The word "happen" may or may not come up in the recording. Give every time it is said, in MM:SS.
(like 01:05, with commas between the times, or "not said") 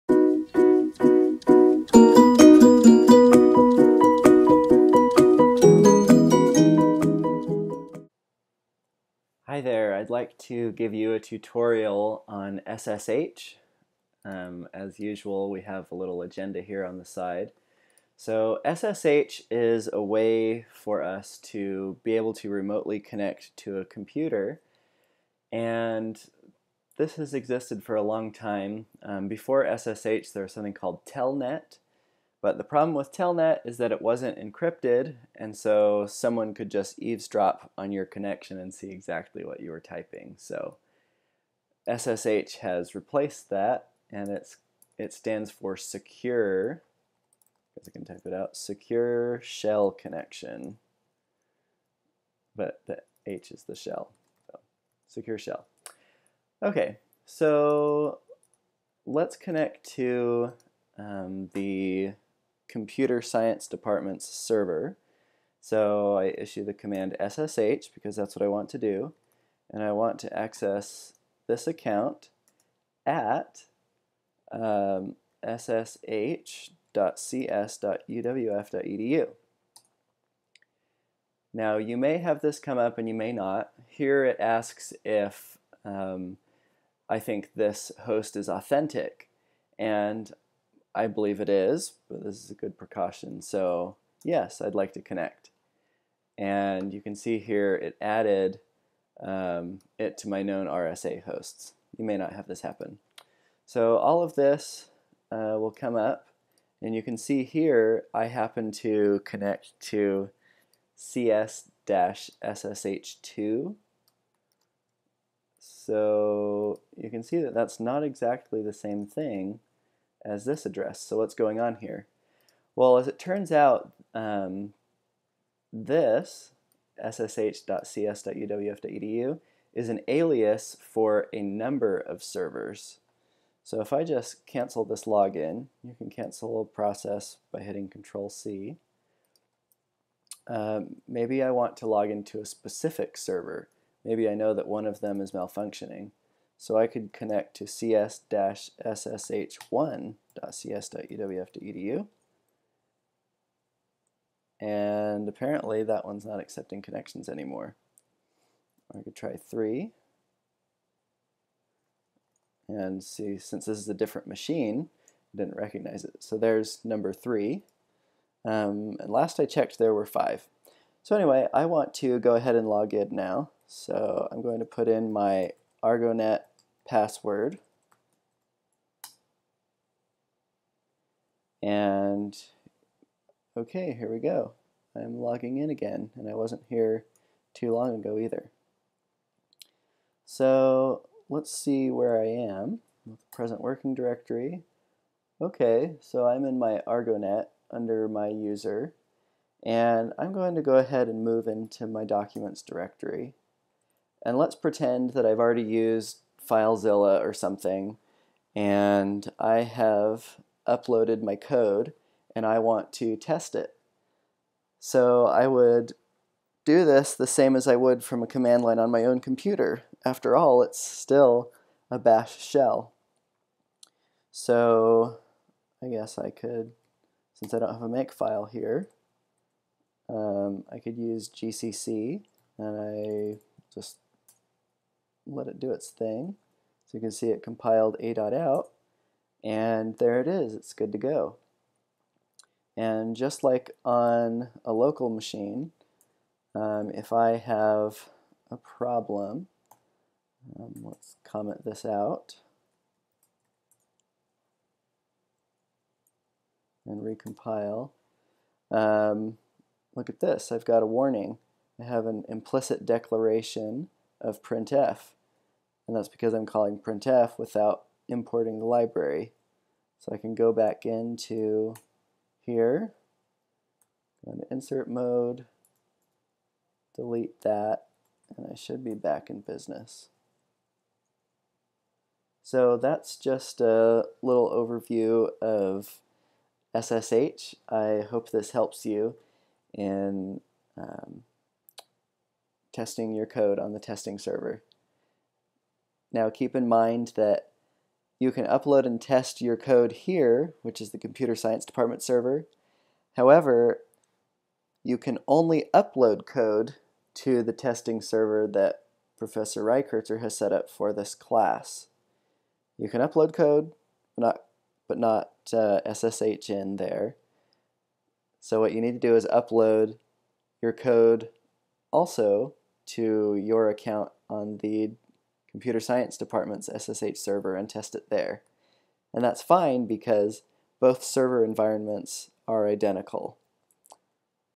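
01:42, 01:48.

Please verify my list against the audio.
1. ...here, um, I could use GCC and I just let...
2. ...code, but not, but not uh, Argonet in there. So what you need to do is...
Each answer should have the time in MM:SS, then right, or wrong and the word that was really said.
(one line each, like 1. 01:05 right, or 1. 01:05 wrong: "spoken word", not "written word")
1. 03:48 right
2. 05:13 wrong: "SSH", not "Argonet".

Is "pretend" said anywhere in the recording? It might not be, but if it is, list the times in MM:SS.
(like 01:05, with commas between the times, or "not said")
03:24.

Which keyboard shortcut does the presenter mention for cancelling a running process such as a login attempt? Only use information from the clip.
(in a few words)
Control C.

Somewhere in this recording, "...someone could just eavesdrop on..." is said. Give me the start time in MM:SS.
00:36.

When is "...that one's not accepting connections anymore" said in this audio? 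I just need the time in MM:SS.
02:35.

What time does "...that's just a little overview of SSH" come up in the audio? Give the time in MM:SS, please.
04:42.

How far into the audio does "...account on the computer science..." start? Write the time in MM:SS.
05:23.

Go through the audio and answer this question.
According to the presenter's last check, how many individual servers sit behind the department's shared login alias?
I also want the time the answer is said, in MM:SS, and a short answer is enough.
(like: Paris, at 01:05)
5, at 02:50.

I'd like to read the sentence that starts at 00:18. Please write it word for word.
So SSH is a way for us to be able to remotely connect to a computer.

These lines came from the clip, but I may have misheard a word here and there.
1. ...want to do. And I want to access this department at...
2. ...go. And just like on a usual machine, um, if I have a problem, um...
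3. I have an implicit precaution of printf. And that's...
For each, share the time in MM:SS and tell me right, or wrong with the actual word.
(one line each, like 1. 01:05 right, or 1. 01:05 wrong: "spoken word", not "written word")
1. 01:08 wrong: "account", not "department"
2. 04:00 wrong: "local", not "usual"
3. 04:21 wrong: "declaration", not "precaution".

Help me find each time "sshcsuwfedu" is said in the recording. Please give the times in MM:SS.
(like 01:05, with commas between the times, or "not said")
01:15, 02:06.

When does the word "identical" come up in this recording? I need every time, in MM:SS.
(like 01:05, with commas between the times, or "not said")
05:32.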